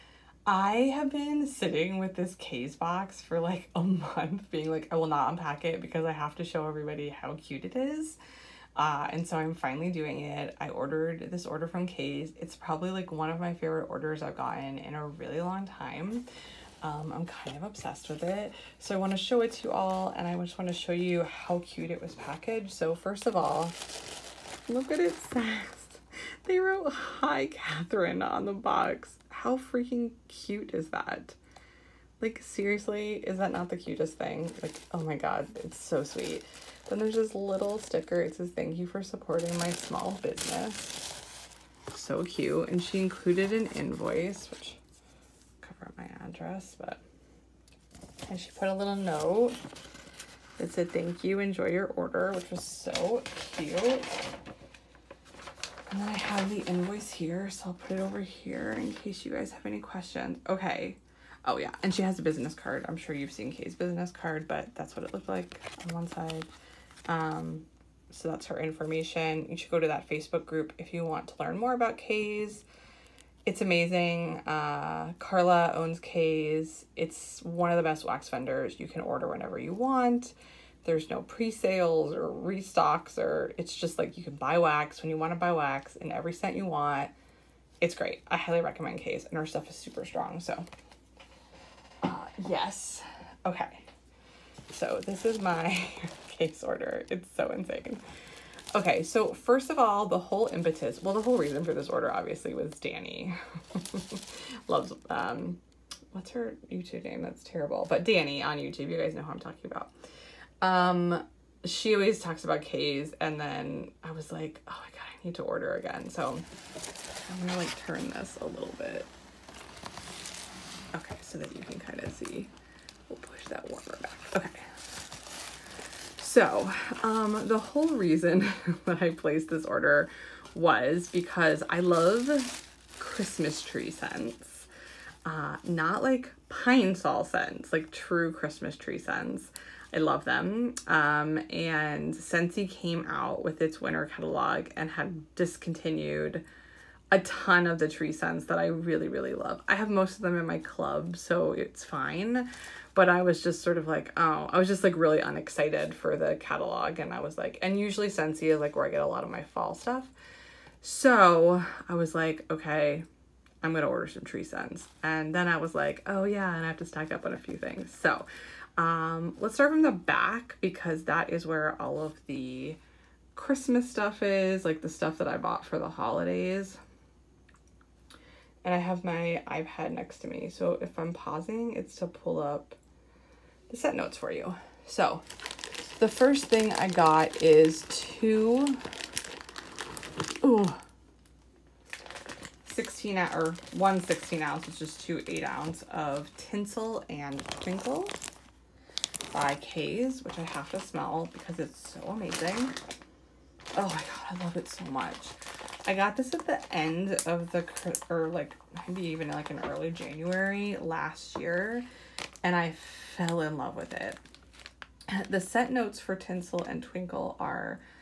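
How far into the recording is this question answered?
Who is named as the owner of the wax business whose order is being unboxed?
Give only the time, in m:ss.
1:15.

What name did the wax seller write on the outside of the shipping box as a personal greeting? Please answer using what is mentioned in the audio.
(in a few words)
Catherine.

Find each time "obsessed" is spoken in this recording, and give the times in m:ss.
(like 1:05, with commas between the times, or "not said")
0:17.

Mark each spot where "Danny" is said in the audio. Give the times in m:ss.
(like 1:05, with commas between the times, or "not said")
1:42, 1:48.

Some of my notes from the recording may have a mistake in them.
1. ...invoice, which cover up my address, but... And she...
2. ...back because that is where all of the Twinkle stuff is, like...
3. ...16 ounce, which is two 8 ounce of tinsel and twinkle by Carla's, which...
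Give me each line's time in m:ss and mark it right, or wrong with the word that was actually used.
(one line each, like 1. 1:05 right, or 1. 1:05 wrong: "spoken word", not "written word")
1. 0:43 right
2. 2:49 wrong: "Christmas", not "Twinkle"
3. 3:14 wrong: "Kae", not "Carla".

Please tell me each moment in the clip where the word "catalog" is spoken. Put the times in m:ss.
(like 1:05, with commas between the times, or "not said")
2:24, 2:36.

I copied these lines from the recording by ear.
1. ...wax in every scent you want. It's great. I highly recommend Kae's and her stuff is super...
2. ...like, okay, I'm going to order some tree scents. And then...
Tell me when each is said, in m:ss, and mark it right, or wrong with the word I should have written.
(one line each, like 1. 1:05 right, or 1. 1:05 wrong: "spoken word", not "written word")
1. 1:25 right
2. 2:42 right.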